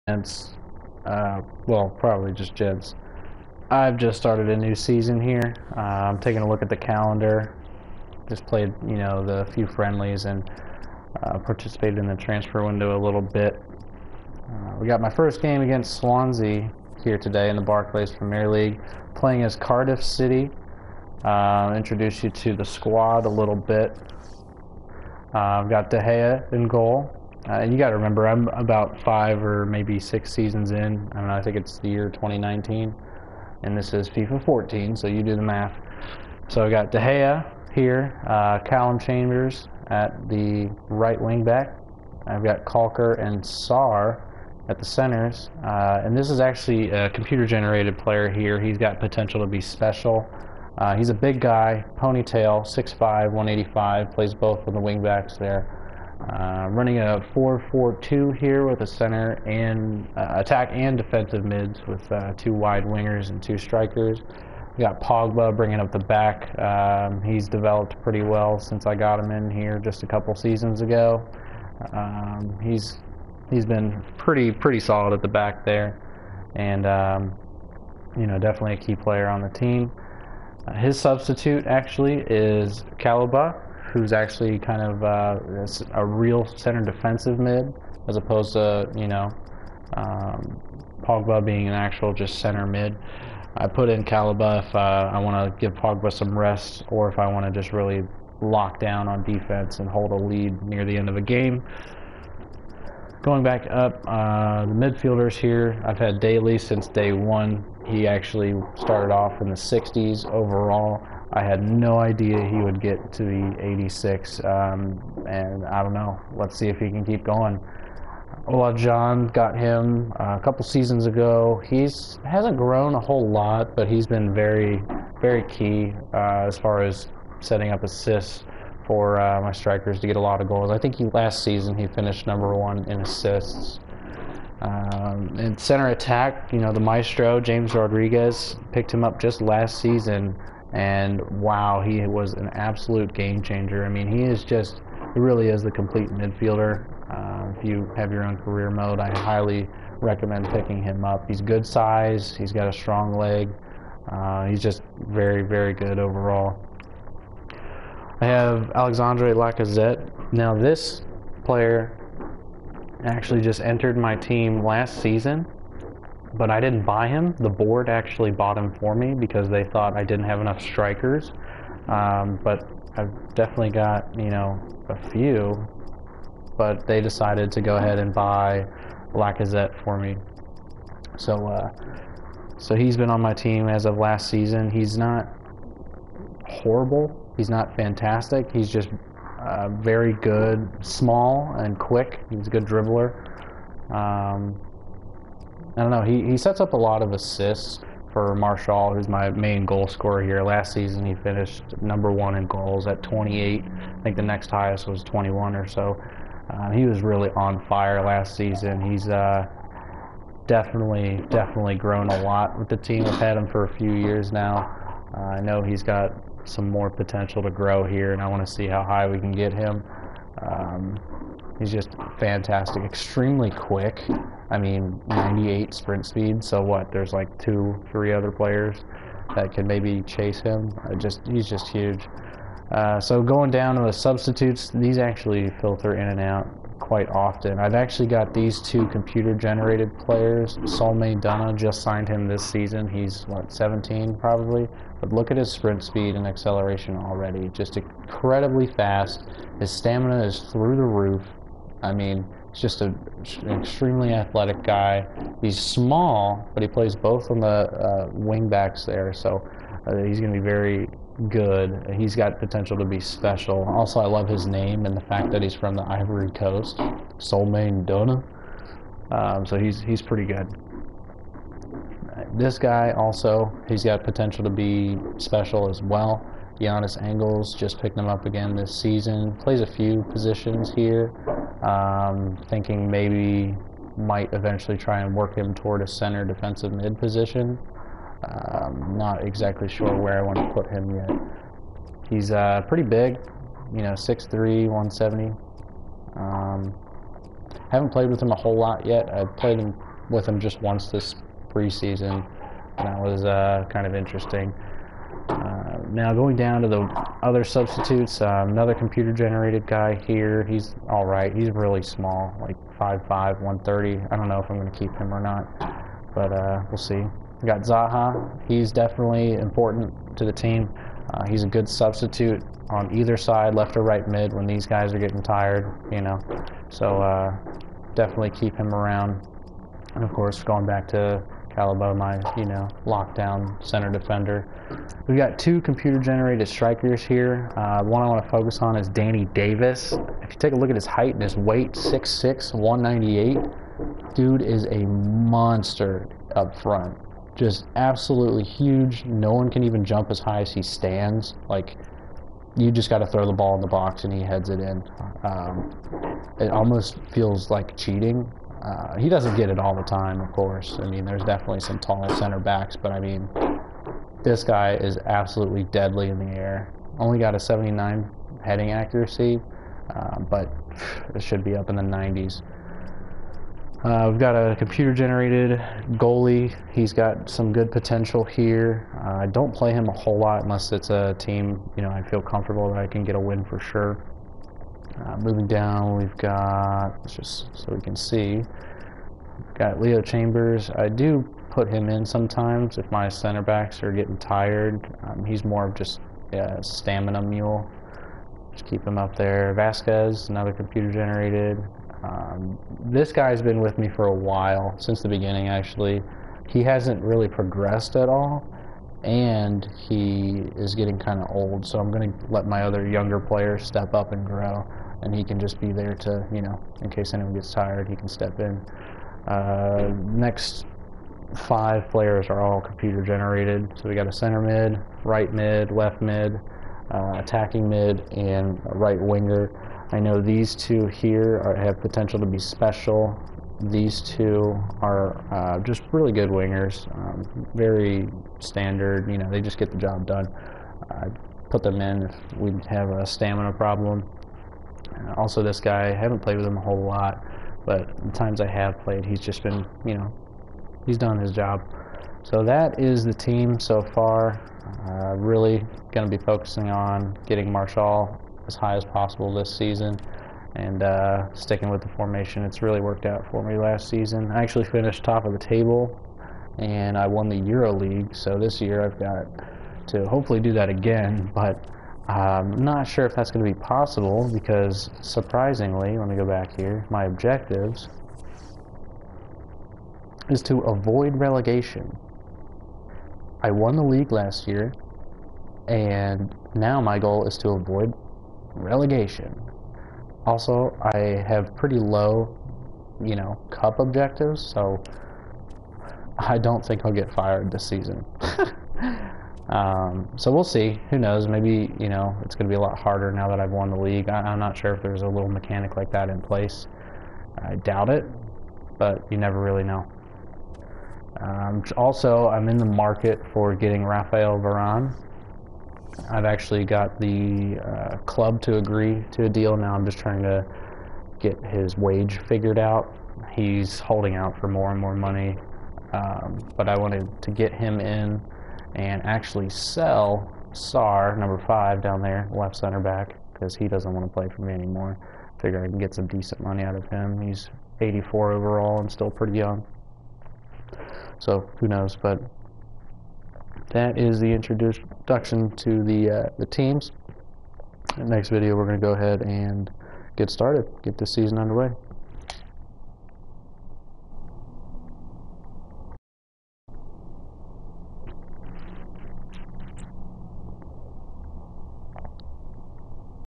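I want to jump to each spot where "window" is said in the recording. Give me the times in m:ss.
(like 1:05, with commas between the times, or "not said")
0:12.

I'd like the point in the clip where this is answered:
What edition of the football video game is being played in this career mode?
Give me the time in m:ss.
0:34.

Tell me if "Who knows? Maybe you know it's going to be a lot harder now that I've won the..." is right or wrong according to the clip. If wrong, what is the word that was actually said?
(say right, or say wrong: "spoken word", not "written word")
right.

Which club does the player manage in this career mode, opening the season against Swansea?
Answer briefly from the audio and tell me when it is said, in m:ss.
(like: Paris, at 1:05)
Cardiff City, at 0:19.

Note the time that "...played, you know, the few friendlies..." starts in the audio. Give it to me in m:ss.
0:08.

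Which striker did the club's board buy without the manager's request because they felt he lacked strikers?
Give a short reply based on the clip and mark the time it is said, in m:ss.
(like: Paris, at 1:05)
Alexandre Lacazette, at 2:38.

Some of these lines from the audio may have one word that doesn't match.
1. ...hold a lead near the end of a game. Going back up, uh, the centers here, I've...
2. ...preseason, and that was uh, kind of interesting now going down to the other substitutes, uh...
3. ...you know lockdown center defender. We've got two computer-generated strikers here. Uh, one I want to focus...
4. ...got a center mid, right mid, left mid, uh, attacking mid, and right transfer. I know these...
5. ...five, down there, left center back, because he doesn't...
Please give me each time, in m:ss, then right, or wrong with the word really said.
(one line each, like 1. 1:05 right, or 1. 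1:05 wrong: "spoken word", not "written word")
1. 1:39 wrong: "midfielders", not "centers"
2. 5:01 right
3. 5:32 right
4. 7:03 wrong: "winger", not "transfer"
5. 8:51 right.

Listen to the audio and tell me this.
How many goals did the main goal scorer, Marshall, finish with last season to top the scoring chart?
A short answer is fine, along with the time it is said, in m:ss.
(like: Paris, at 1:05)
28, at 3:23.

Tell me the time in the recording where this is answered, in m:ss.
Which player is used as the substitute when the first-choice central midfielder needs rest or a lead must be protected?
1:22.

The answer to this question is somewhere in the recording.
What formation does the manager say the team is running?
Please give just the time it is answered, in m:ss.
0:57.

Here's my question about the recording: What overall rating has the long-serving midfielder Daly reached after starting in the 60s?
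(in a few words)
86.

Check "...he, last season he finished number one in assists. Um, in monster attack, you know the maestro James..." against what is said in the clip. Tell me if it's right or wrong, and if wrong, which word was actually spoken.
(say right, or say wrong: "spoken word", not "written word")
wrong: "center", not "monster".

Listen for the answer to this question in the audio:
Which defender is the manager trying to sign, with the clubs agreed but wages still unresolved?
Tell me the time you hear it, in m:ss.
8:33.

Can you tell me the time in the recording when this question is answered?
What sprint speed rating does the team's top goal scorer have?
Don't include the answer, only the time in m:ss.
3:45.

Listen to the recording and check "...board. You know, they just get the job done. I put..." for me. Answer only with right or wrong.
wrong.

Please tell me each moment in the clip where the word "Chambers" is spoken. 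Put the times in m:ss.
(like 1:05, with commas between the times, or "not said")
0:38, 6:30.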